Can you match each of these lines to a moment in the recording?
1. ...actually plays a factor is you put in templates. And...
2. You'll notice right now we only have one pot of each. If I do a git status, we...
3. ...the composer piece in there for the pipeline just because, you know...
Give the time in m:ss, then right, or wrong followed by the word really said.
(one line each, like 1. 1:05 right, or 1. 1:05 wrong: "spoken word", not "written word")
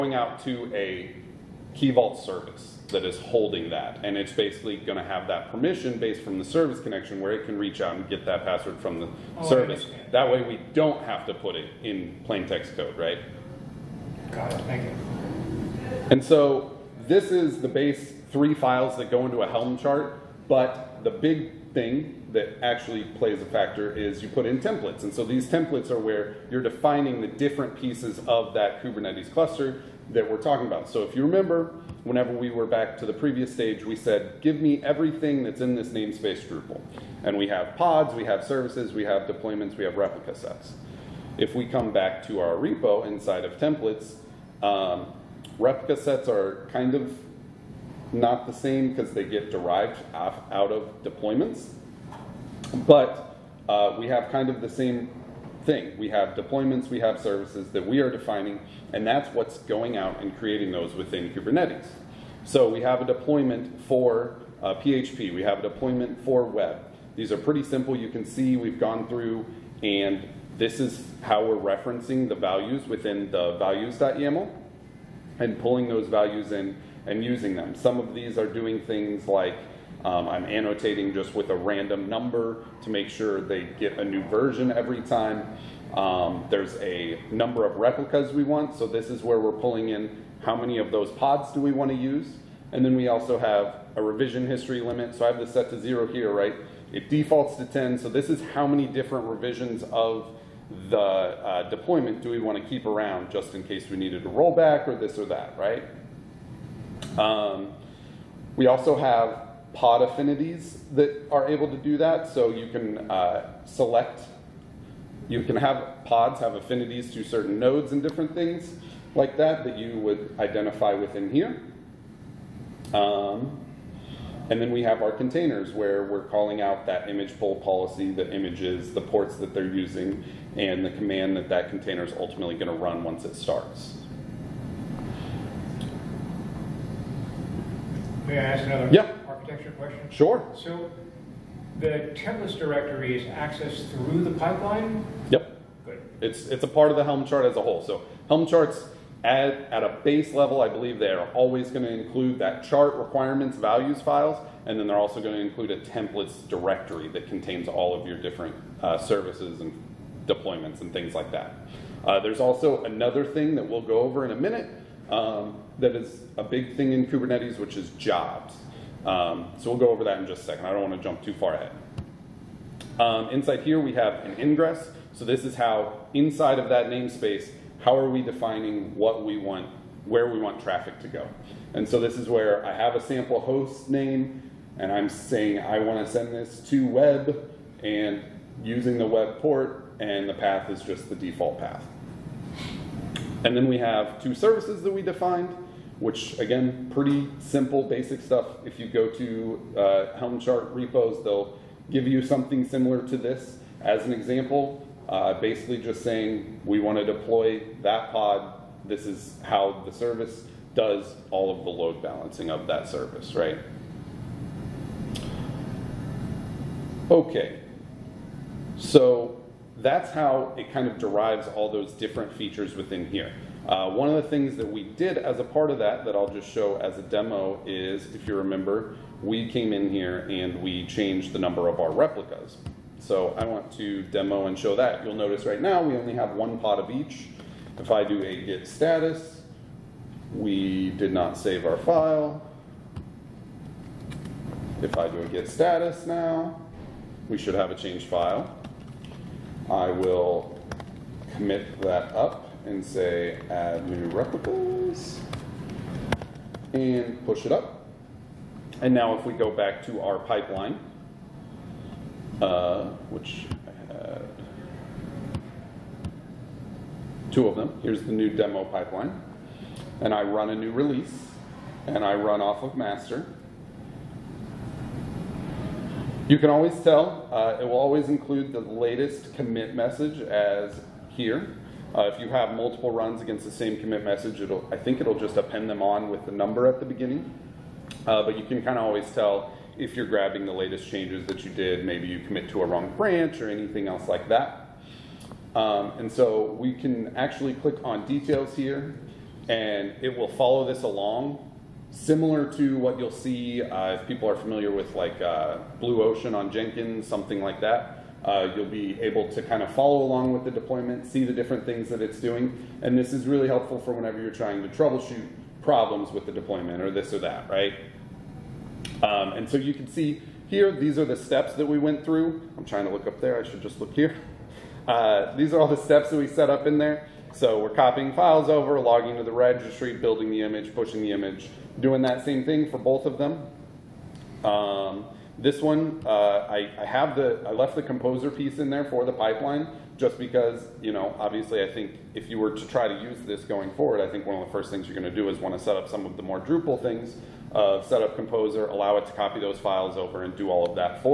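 1. 0:22 right
2. 3:55 right
3. 5:37 right.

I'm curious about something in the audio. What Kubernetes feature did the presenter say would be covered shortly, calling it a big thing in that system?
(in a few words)
jobs.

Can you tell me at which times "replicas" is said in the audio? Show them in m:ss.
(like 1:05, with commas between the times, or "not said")
0:39, 0:45, 1:27, 3:51, 4:14.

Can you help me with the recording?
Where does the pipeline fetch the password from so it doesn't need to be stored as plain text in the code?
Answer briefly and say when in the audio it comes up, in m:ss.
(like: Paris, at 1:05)
Key Vault, at 0:01.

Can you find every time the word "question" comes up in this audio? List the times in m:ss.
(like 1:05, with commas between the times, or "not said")
2:19.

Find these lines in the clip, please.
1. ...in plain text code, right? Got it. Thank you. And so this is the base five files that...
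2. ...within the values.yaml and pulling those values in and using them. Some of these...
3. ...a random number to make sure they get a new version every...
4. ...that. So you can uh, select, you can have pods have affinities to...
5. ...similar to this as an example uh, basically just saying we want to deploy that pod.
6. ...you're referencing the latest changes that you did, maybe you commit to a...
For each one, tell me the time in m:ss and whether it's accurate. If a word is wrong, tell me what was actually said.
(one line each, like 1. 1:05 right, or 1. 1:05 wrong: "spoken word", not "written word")
1. 0:11 wrong: "three", not "five"
2. 1:12 right
3. 1:21 right
4. 1:51 right
5. 3:22 right
6. 4:49 wrong: "grabbing", not "referencing".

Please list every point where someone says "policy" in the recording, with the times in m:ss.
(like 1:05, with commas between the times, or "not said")
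2:07.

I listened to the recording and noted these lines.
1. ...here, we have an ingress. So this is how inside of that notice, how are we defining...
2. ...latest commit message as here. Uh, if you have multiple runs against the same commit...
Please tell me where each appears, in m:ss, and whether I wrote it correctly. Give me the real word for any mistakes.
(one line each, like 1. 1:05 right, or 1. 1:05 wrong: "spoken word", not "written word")
1. 2:53 wrong: "namespace", not "notice"
2. 4:38 right.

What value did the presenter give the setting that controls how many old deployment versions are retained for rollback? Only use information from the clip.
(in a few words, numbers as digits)
0.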